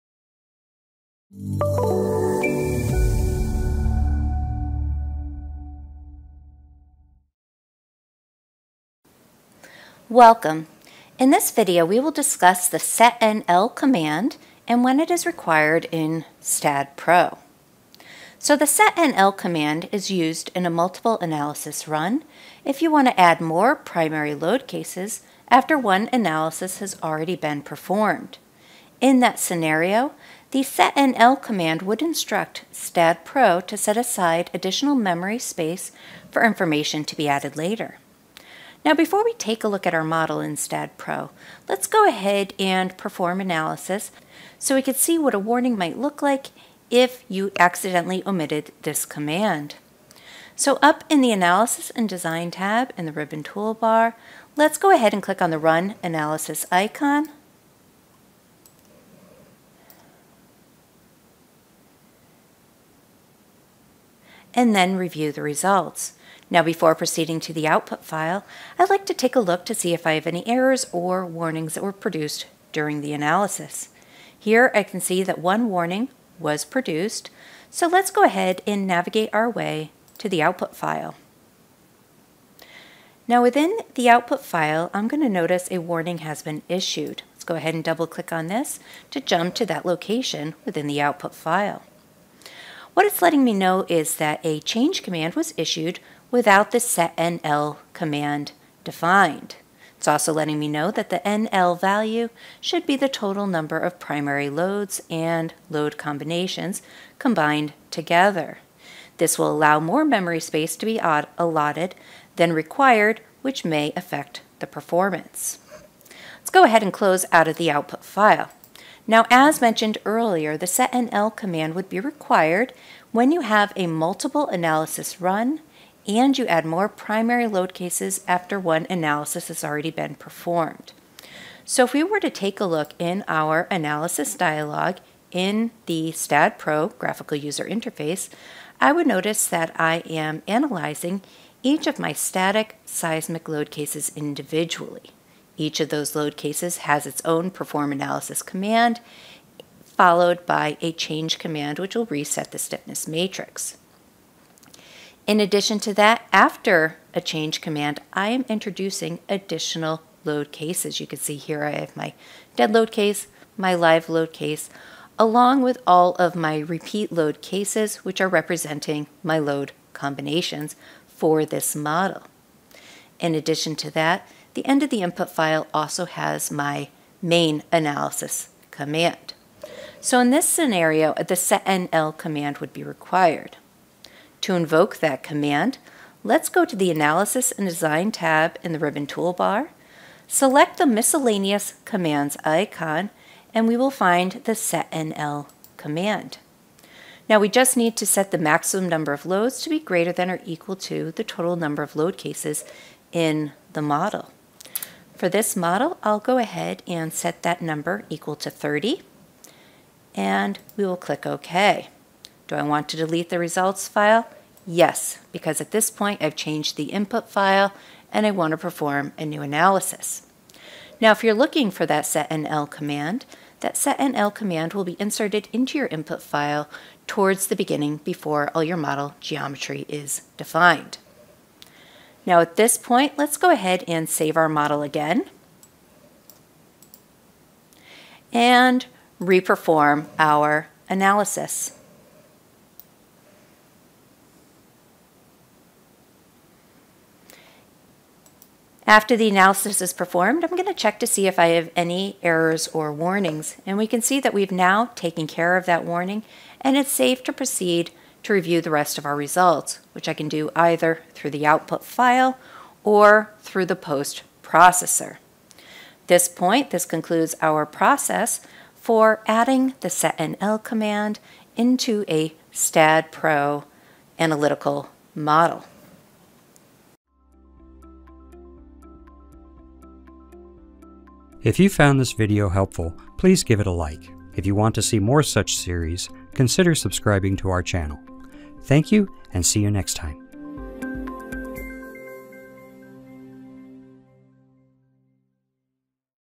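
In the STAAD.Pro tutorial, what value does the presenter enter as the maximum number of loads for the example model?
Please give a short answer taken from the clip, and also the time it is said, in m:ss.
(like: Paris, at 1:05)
30, at 3:28.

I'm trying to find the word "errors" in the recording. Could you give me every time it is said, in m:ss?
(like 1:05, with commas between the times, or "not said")
1:10, 4:12.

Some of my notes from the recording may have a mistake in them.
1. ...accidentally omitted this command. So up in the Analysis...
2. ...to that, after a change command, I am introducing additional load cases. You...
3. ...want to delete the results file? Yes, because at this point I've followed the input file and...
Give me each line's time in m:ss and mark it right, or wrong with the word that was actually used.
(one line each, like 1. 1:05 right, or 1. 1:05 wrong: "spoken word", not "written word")
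1. 0:47 right
2. 2:35 right
3. 3:32 wrong: "changed", not "followed".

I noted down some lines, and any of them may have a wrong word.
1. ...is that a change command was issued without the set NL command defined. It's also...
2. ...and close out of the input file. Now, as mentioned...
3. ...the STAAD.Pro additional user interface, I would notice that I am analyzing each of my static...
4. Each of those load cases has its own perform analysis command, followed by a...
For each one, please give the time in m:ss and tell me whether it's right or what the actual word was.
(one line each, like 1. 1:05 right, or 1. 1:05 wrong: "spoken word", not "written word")
1. 1:33 right
2. 1:56 wrong: "output", not "input"
3. 2:15 wrong: "graphical", not "additional"
4. 2:25 right.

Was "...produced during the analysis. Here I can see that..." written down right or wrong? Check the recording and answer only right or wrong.
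right.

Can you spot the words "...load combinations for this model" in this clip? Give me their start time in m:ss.
2:49.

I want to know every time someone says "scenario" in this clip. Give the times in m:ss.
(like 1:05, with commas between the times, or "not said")
0:29, 3:00.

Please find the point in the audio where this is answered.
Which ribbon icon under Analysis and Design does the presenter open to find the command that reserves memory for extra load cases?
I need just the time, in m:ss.
3:10.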